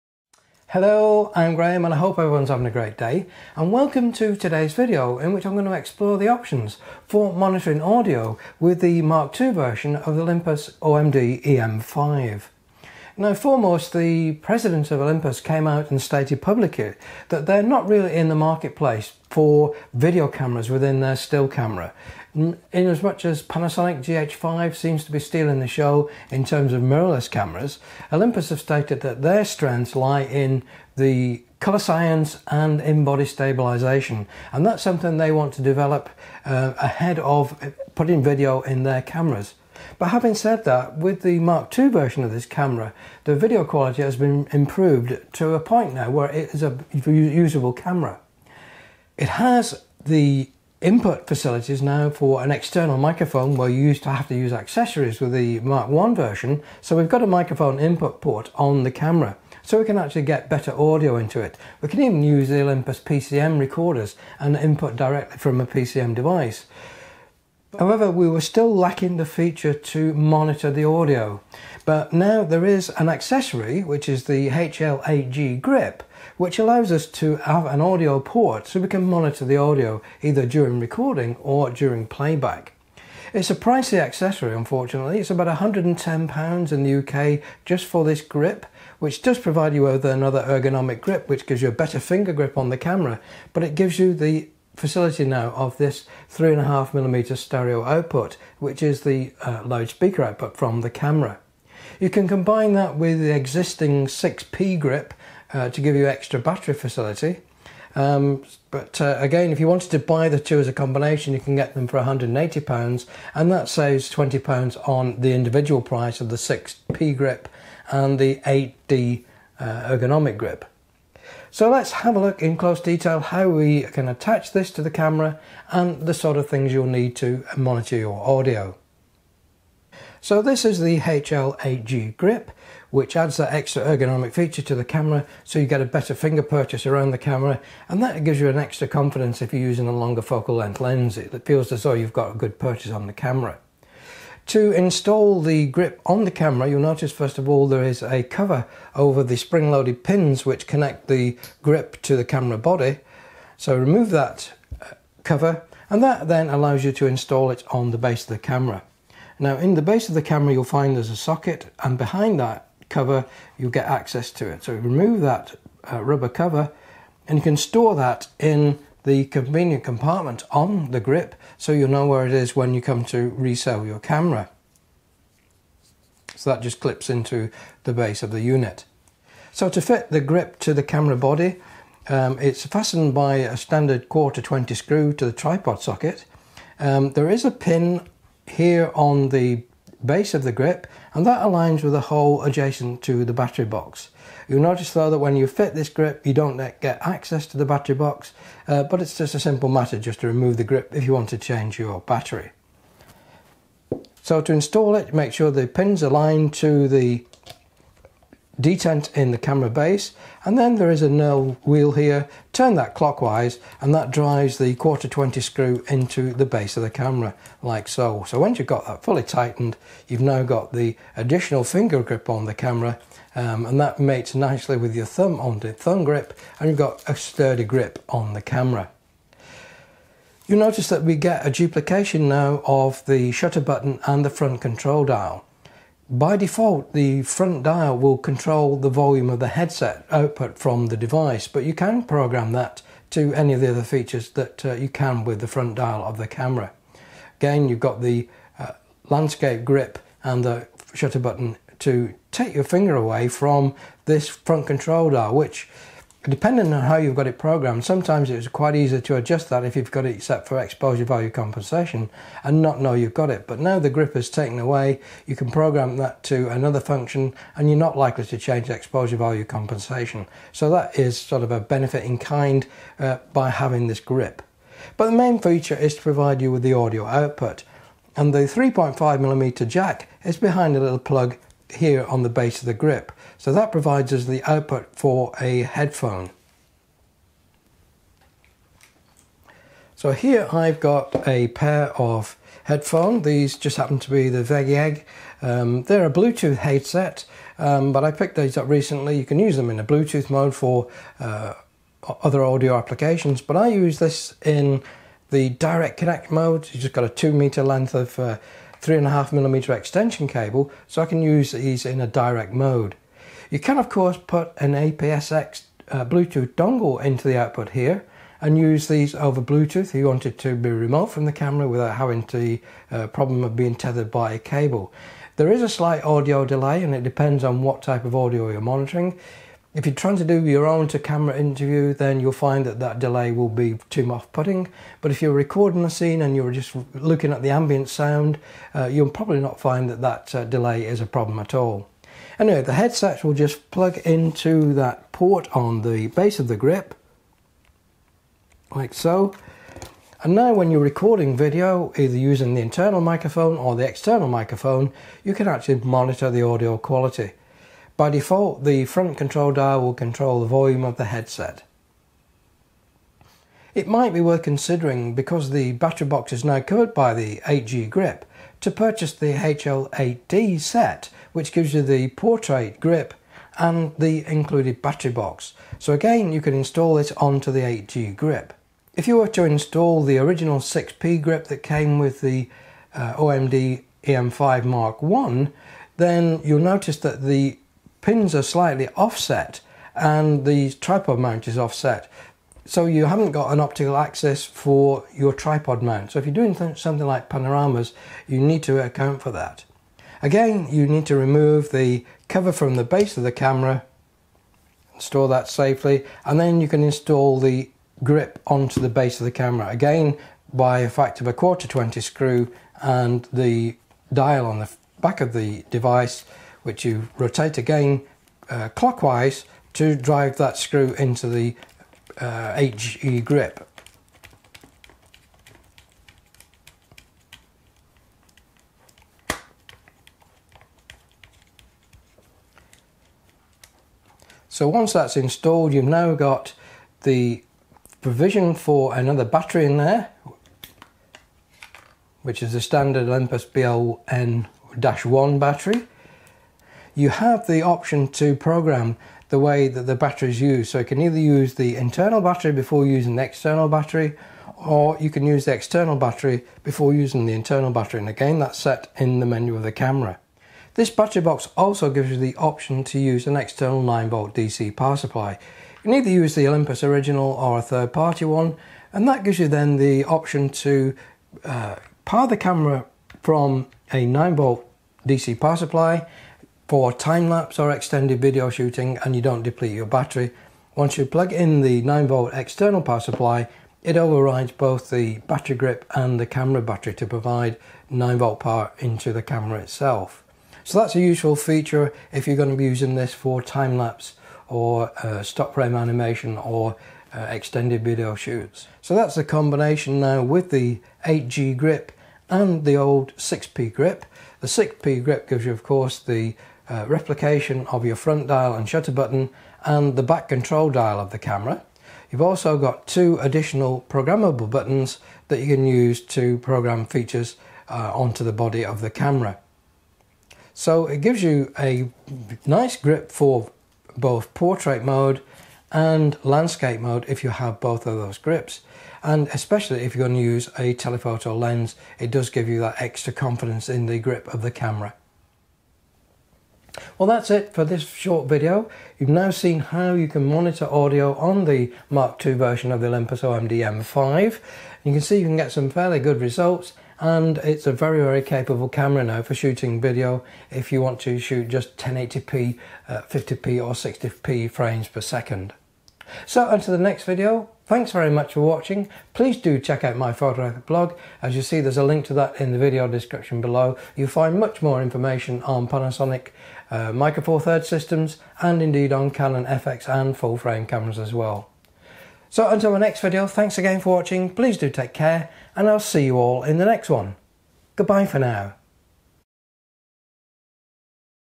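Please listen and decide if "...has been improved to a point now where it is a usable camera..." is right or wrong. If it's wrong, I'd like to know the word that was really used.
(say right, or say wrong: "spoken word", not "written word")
right.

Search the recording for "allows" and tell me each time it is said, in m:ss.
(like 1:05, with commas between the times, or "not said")
1:16, 2:36.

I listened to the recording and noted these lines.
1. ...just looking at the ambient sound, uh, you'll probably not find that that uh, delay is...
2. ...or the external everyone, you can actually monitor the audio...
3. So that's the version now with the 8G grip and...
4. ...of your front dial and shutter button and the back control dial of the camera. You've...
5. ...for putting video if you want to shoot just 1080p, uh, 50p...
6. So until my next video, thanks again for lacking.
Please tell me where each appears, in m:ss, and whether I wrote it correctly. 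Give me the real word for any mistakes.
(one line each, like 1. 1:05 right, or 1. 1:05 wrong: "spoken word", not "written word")
1. 5:36 right
2. 5:53 wrong: "microphone", not "everyone"
3. 8:18 wrong: "combination", not "version"
4. 8:27 right
5. 9:09 wrong: "shooting", not "putting"
6. 9:32 wrong: "watching", not "lacking".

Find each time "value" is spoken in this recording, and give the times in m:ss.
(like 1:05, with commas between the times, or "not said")
4:21, 4:29.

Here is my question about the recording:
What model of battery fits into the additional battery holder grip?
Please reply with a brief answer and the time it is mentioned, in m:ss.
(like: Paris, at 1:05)
BLN-1, at 7:23.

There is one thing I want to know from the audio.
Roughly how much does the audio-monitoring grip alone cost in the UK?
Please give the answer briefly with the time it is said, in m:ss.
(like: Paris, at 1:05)
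£110, at 1:25.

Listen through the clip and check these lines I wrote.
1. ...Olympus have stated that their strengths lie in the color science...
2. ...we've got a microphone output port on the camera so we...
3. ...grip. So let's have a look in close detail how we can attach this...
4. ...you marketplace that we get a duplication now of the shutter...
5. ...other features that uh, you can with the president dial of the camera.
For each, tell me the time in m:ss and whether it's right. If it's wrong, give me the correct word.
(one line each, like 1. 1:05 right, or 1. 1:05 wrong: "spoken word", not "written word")
1. 0:28 right
2. 0:56 wrong: "input", not "output"
3. 2:00 right
4. 3:50 wrong: "notice", not "marketplace"
5. 4:03 wrong: "front", not "president".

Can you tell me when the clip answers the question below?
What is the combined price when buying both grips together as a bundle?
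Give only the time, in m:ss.
1:51.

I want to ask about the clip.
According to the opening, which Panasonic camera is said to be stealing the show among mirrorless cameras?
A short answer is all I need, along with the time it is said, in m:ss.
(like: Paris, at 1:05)
GH5, at 0:24.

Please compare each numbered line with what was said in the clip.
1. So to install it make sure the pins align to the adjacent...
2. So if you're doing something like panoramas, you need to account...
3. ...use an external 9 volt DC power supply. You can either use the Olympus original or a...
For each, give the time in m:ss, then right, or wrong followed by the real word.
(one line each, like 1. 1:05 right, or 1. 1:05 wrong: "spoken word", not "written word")
1. 3:24 wrong: "detent", not "adjacent"
2. 6:36 right
3. 7:42 right.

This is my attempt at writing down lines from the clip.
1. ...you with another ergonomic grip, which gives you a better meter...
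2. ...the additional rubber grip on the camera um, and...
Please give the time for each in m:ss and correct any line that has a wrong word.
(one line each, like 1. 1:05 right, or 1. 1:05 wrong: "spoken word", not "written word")
1. 1:29 wrong: "finger", not "meter"
2. 3:40 wrong: "finger", not "rubber".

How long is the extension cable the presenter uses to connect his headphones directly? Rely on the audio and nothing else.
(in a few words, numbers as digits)
2 meters.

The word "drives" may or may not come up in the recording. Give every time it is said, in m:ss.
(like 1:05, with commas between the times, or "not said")
3:34, 6:59.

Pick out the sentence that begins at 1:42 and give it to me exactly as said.
You can combine that with the existing 6P grip uh, to give you extra battery facility.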